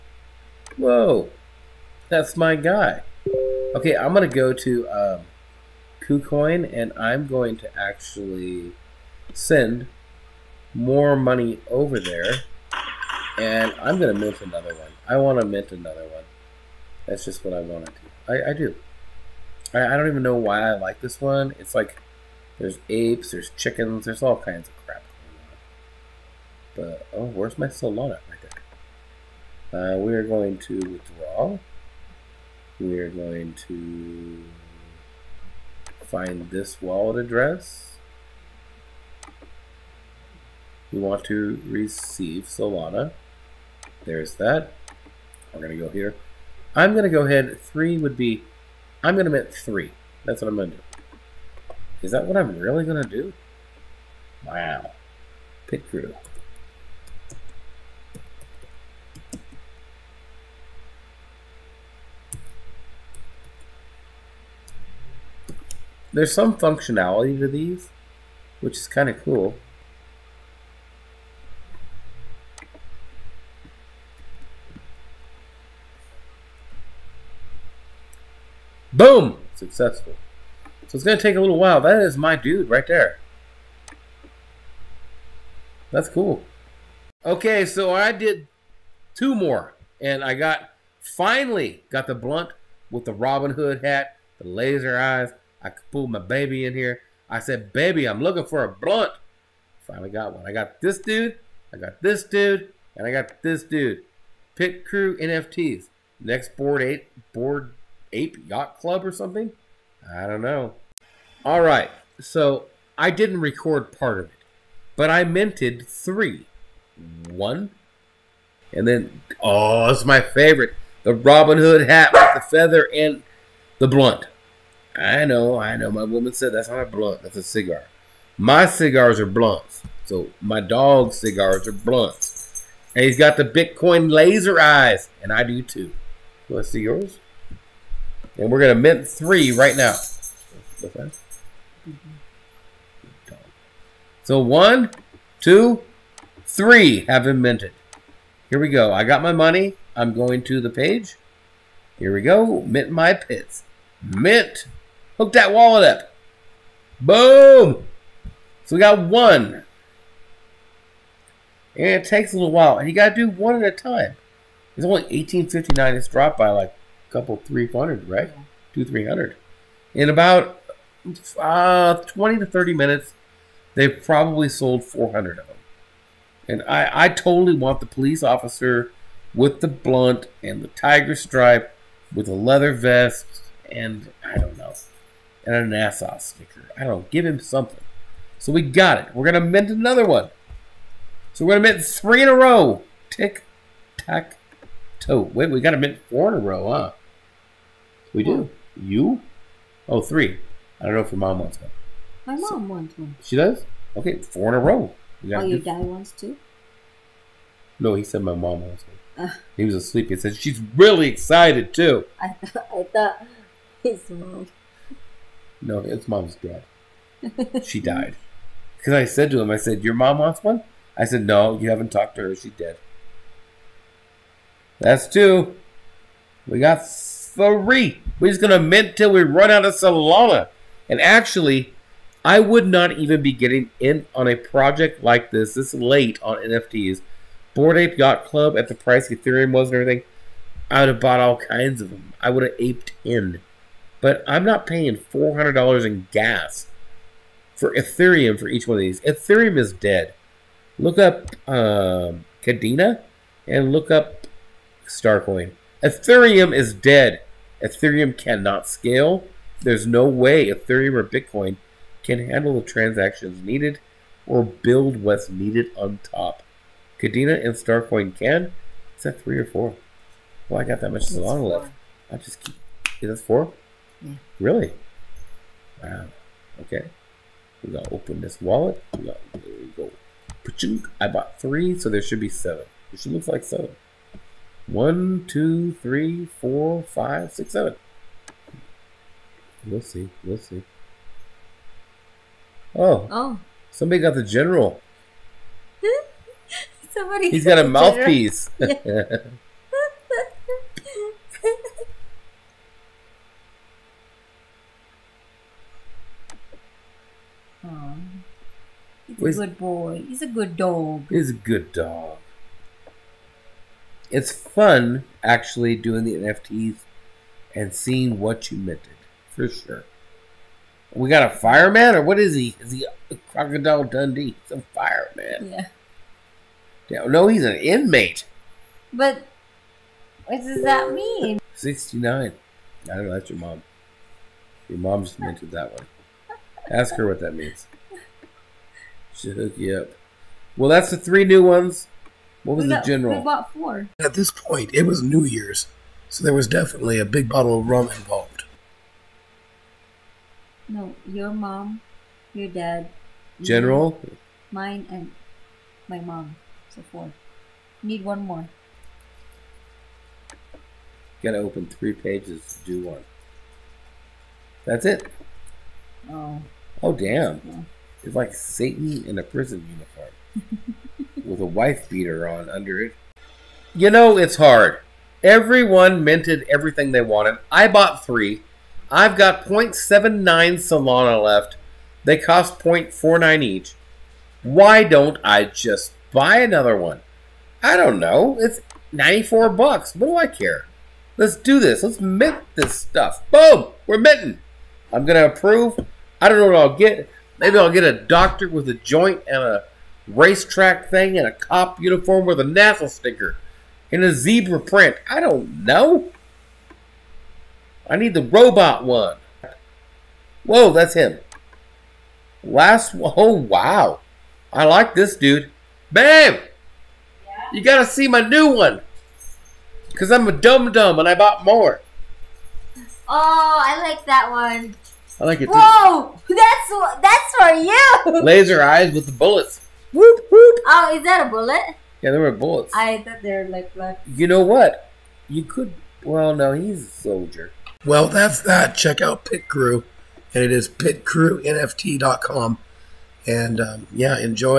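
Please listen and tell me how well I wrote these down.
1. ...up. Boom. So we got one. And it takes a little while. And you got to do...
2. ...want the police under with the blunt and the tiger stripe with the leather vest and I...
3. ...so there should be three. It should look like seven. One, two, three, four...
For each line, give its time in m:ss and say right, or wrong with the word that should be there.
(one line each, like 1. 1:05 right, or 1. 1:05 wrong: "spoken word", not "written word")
1. 2:35 right
2. 2:57 wrong: "officer", not "under"
3. 4:41 wrong: "seven", not "three".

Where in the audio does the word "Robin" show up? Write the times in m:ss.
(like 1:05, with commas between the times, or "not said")
1:33, 2:01.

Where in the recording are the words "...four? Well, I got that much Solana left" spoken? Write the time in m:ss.
4:29.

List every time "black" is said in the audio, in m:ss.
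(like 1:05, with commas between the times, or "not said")
7:13.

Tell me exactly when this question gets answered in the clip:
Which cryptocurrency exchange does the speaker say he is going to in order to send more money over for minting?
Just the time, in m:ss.
0:06.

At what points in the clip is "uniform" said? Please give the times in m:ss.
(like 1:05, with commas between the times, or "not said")
6:09, 6:41.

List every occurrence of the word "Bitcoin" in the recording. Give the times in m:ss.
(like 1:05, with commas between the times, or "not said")
2:13, 4:21.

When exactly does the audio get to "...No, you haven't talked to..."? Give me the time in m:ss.
3:41.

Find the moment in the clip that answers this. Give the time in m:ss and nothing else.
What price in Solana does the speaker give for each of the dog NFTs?
6:22.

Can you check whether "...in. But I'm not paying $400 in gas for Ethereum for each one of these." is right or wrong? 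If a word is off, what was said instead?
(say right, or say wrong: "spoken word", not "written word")
right.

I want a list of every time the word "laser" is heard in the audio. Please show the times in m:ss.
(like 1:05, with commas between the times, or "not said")
1:34, 2:14, 7:08.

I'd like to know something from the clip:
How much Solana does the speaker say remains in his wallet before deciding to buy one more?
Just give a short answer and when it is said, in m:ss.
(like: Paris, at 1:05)
0.79 Solana, at 6:19.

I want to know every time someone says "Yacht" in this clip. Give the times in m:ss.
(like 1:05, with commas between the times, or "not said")
1:48, 3:57.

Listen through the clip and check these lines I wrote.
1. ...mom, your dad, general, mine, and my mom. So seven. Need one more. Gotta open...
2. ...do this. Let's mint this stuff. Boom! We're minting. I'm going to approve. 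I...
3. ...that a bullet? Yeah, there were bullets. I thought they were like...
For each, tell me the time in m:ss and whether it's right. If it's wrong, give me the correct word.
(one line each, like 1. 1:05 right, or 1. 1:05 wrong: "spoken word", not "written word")
1. 5:51 wrong: "four", not "seven"
2. 6:31 right
3. 7:11 right.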